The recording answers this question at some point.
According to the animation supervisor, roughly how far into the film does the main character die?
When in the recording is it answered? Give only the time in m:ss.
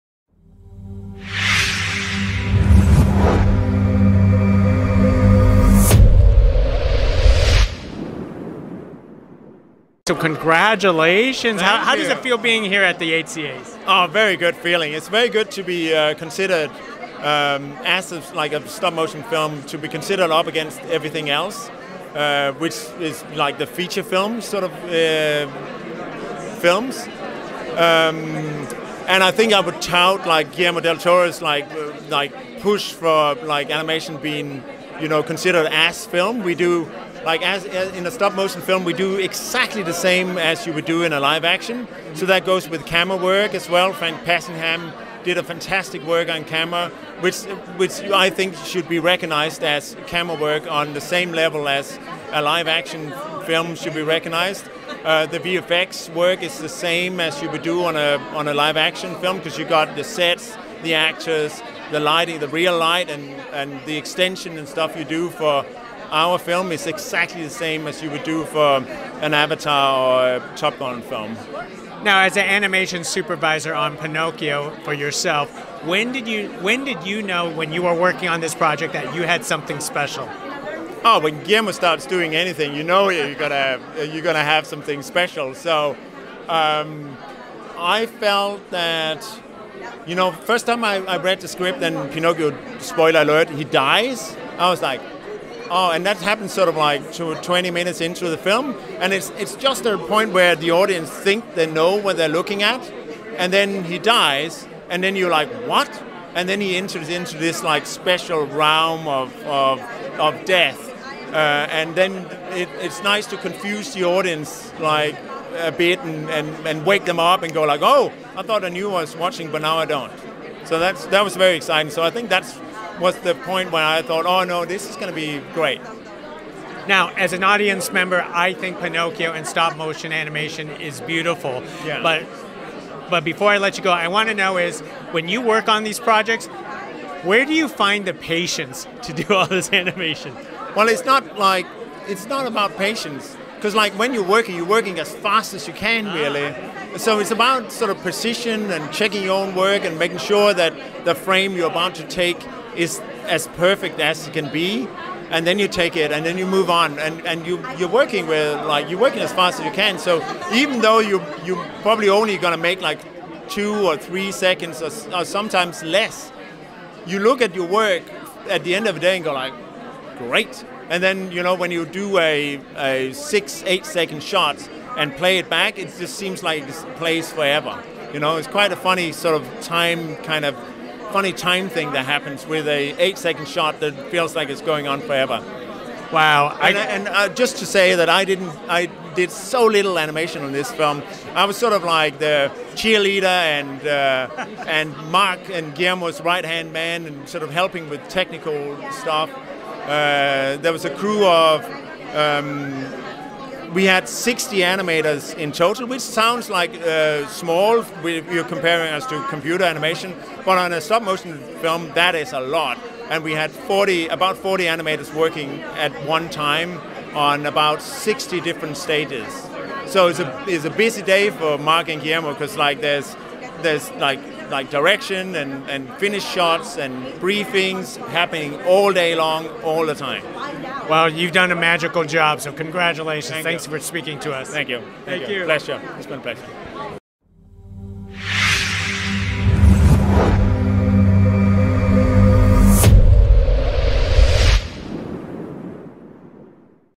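1:37.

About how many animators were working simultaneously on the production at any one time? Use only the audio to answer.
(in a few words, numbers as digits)
40.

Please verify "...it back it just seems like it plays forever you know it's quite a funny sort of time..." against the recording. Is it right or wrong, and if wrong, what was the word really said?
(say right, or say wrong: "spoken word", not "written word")
right.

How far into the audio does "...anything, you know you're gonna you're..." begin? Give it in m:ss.
1:22.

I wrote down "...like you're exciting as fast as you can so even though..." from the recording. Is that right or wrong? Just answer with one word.
wrong.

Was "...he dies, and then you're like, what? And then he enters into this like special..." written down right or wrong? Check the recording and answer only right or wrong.
right.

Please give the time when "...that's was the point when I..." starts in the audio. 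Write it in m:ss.
2:02.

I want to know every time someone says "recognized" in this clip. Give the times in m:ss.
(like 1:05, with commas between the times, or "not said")
0:48, 0:54.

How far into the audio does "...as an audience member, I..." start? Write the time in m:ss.
2:07.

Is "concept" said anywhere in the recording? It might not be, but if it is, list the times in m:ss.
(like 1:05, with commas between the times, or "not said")
not said.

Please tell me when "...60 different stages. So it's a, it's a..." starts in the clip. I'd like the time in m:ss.
3:37.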